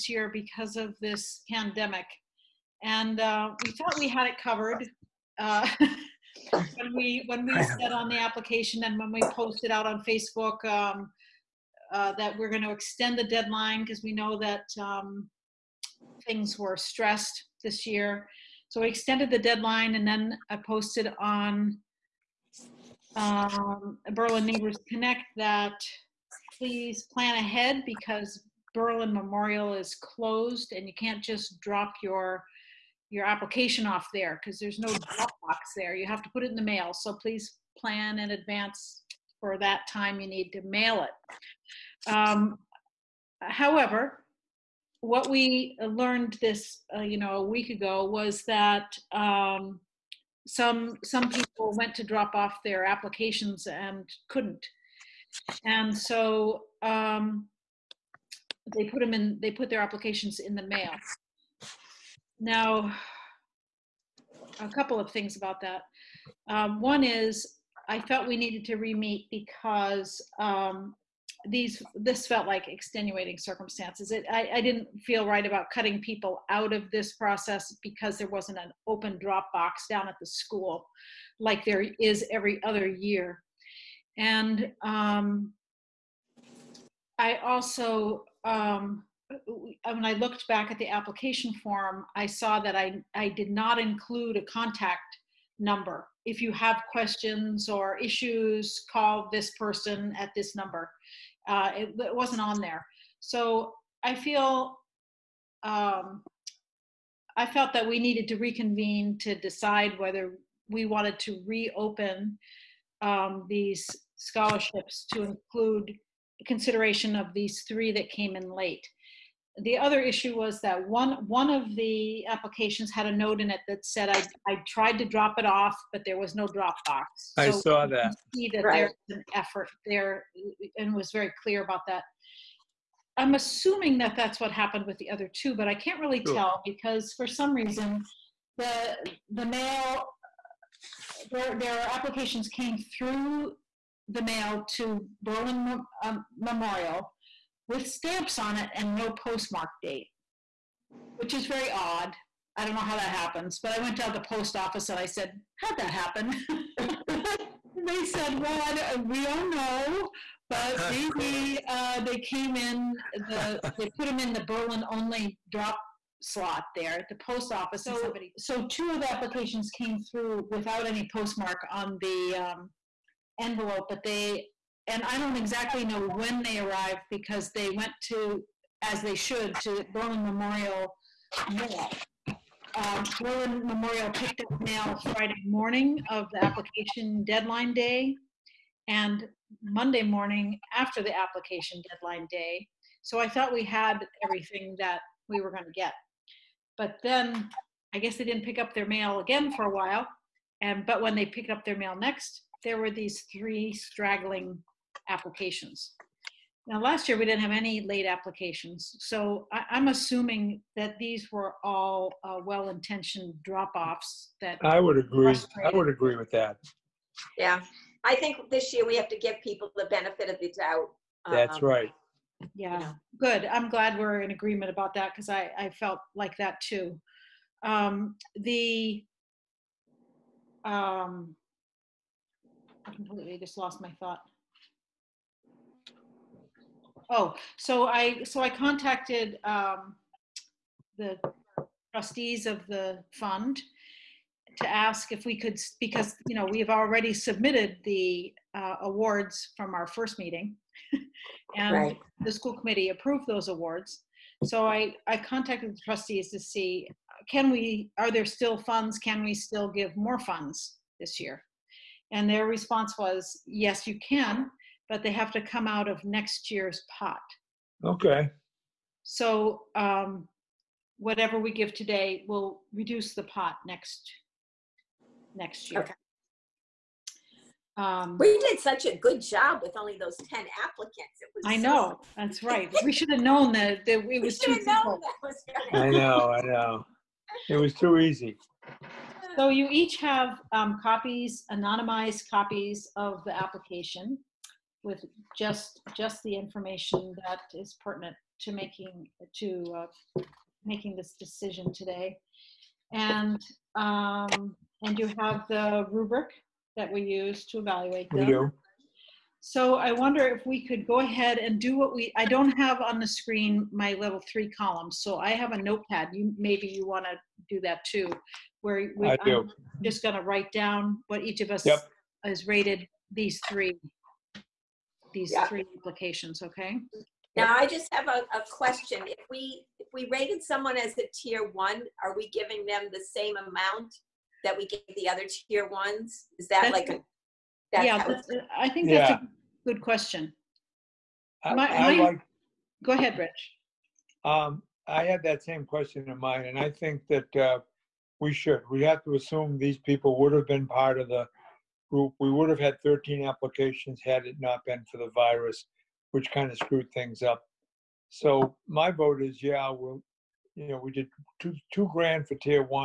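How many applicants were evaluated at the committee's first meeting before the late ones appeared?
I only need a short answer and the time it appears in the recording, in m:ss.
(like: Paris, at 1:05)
10, at 4:40.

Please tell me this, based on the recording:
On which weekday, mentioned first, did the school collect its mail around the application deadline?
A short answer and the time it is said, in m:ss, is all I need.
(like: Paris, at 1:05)
Friday, at 3:05.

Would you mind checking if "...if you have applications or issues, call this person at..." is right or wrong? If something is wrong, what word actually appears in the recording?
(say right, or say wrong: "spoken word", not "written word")
wrong: "questions", not "applications".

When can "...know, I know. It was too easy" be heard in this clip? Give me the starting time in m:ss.
4:45.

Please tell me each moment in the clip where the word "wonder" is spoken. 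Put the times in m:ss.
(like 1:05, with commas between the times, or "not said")
5:09.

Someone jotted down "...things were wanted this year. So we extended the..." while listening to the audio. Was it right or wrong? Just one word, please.
wrong.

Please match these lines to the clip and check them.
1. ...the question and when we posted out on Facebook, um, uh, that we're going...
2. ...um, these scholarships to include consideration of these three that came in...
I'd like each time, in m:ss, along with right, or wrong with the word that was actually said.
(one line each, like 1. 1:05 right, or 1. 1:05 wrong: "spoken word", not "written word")
1. 0:08 wrong: "application", not "question"
2. 1:53 right.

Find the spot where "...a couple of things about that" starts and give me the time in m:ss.
1:04.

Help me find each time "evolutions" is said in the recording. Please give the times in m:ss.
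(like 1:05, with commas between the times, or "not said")
not said.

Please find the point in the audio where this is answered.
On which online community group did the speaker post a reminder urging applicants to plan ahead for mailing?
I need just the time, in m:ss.
0:24.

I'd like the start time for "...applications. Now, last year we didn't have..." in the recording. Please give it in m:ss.
3:25.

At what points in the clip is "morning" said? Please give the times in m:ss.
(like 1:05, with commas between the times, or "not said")
3:05, 3:10.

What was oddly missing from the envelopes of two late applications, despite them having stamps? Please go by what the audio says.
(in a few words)
postmark date.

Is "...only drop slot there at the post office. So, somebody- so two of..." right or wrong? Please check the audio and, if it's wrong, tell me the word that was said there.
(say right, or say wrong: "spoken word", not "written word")
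right.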